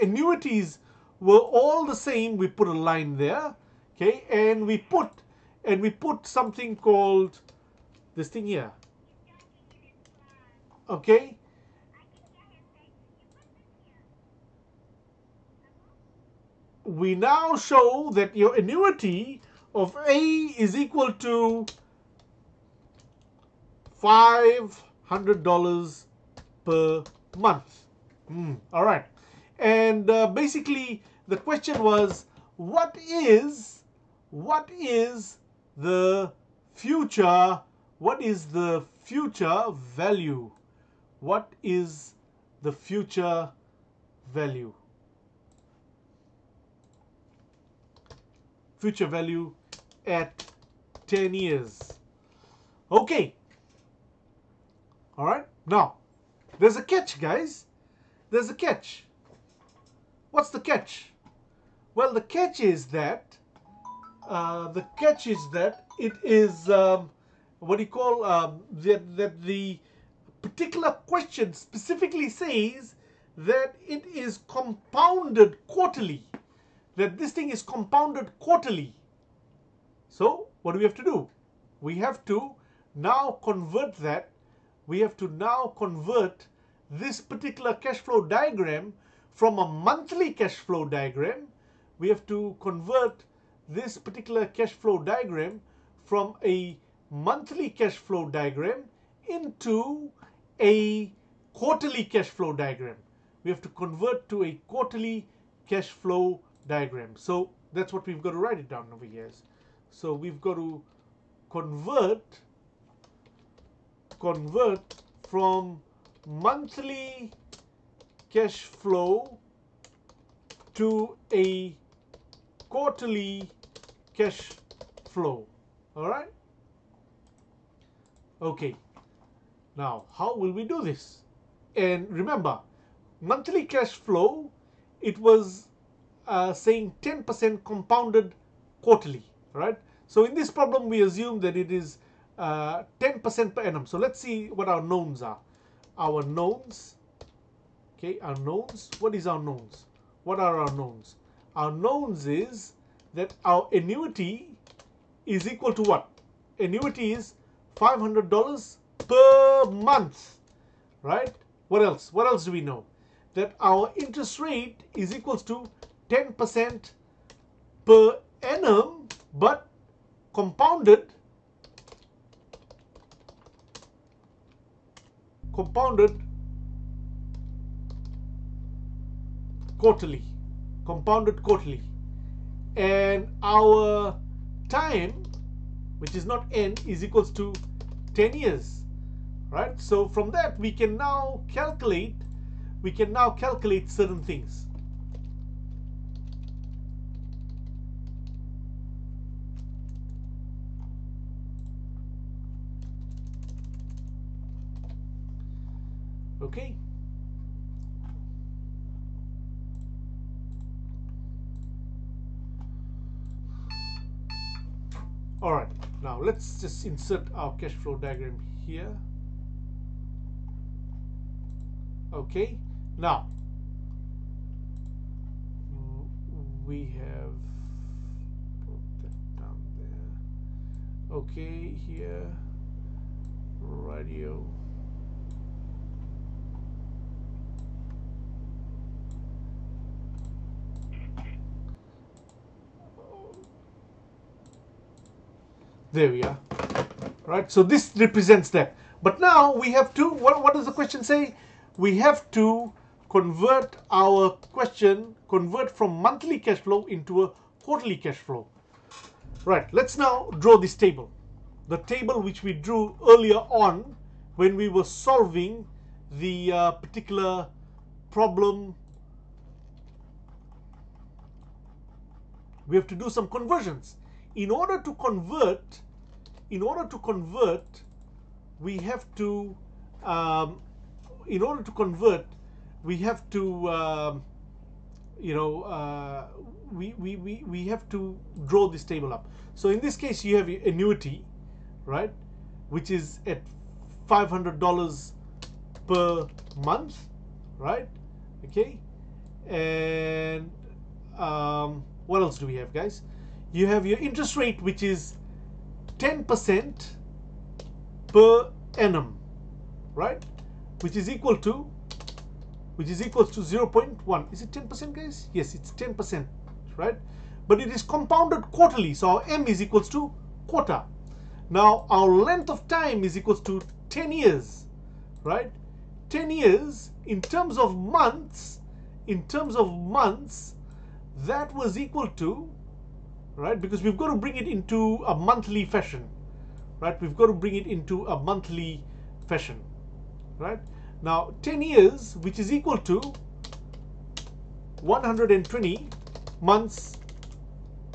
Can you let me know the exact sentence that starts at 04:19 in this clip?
Right, let's now draw this table.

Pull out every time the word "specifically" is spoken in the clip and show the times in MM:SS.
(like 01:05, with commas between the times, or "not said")
01:11.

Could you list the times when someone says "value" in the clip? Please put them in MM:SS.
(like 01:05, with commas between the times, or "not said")
00:39, 00:44, 00:49.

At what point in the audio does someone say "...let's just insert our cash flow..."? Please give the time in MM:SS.
03:36.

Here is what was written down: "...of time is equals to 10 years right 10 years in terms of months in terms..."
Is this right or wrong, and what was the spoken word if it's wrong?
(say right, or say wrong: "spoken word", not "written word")
right.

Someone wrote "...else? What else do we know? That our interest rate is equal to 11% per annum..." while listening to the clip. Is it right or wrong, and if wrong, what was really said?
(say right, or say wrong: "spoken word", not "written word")
wrong: "10", not "11".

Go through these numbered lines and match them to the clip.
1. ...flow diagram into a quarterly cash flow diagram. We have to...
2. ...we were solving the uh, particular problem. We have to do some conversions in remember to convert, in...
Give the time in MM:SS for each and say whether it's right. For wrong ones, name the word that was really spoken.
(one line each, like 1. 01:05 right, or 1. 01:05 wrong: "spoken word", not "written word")
1. 01:37 right
2. 04:24 wrong: "order", not "remember".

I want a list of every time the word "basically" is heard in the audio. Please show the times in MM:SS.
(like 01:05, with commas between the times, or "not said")
00:30.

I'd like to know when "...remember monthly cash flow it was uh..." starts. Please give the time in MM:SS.
02:12.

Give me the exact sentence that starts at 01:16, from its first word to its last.
That this thing is compounded quarterly.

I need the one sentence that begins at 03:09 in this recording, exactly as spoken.
So from that, we can now calculate, we can now calculate certain things.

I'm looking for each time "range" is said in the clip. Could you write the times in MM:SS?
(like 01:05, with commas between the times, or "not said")
not said.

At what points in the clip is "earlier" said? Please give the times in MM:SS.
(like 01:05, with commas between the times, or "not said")
04:23.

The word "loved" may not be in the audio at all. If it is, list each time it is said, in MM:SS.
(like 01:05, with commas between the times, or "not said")
not said.